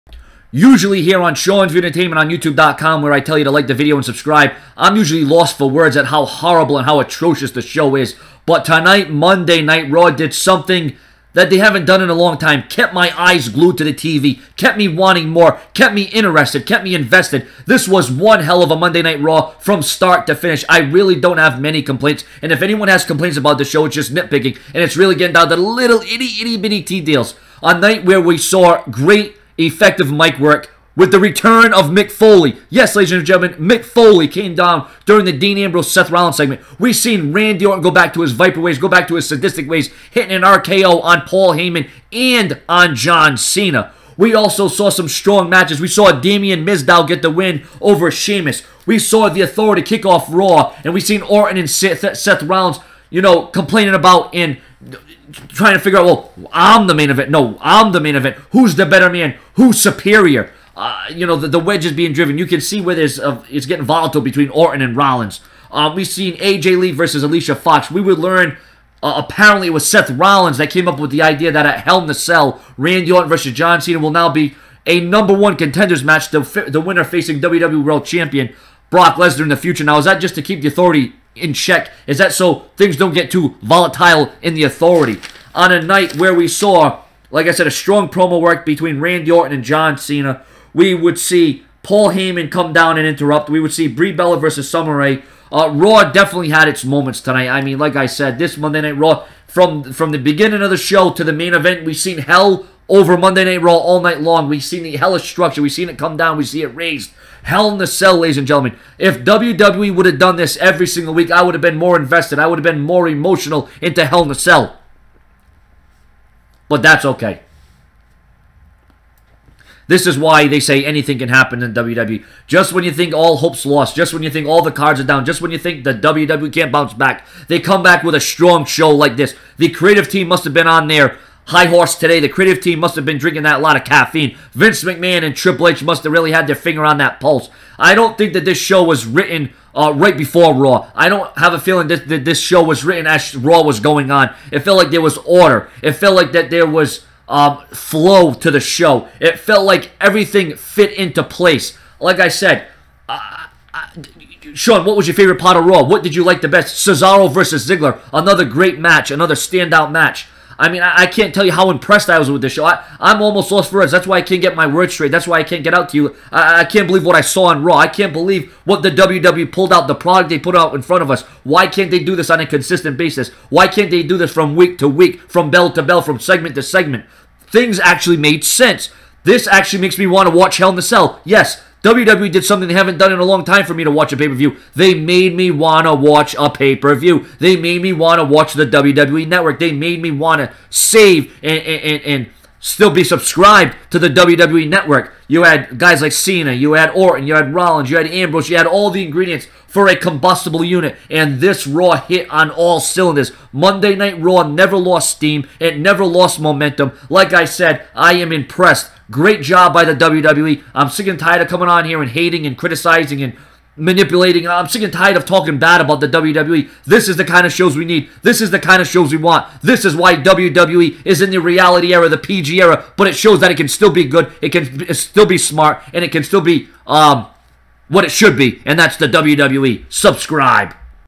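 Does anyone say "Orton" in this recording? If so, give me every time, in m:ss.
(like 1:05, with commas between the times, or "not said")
0:37, 0:51, 1:04, 1:13, 1:29, 3:16.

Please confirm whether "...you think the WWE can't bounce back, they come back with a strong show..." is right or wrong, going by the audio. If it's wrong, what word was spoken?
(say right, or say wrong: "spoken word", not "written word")
right.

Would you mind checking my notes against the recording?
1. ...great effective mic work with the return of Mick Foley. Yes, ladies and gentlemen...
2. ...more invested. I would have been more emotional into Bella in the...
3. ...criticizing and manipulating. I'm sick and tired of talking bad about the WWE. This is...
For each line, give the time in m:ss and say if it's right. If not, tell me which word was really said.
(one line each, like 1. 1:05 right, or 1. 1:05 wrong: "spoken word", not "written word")
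1. 0:28 right
2. 1:51 wrong: "Hell", not "Bella"
3. 3:32 right.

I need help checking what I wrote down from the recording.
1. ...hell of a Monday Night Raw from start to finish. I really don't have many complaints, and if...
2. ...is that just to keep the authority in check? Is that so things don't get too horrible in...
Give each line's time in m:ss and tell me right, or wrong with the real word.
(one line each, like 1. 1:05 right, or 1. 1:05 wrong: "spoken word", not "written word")
1. 0:18 right
2. 1:19 wrong: "volatile", not "horrible".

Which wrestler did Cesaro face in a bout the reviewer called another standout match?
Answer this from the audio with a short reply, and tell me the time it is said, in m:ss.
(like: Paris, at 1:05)
Ziggler, at 2:37.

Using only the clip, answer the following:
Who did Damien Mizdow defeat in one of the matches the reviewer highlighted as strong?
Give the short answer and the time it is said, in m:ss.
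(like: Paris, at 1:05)
Sheamus, at 0:48.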